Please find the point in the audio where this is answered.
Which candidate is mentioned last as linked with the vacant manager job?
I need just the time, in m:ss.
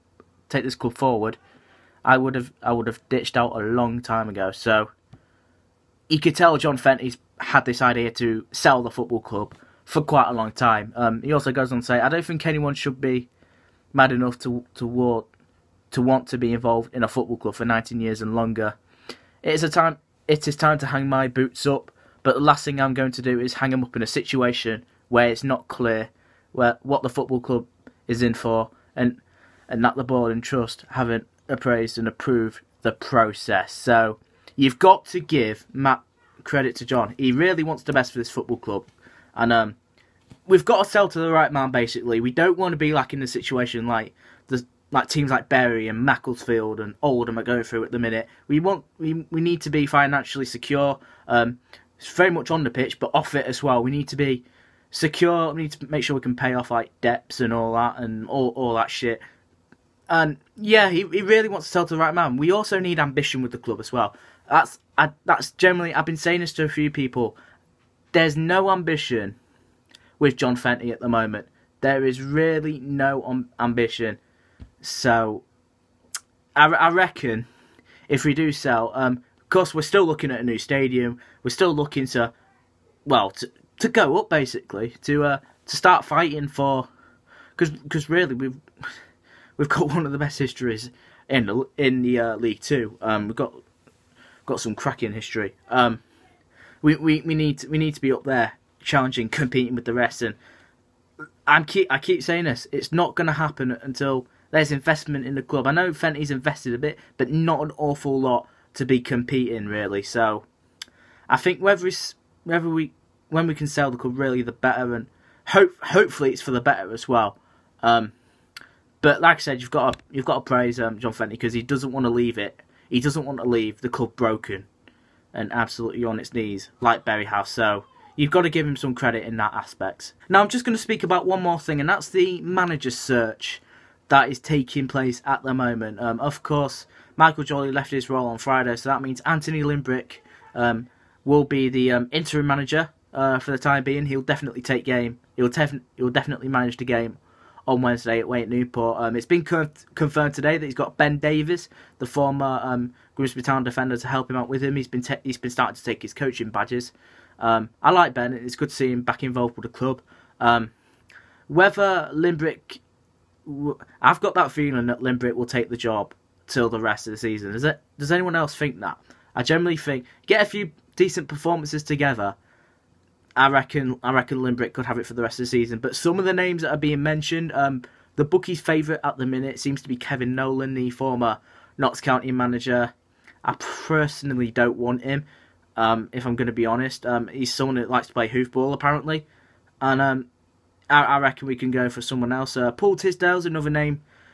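3:12.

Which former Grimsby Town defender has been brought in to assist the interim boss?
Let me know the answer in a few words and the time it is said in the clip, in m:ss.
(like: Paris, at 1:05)
Ben Davies, at 2:30.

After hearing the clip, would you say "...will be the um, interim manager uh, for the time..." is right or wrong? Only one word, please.
right.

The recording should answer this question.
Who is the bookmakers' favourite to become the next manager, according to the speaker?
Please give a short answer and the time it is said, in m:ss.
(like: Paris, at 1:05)
Kevin Nolan, at 2:59.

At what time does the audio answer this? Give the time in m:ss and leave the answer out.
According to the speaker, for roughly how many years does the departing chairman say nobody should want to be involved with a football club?
0:17.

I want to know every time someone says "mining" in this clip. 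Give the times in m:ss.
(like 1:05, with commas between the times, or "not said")
not said.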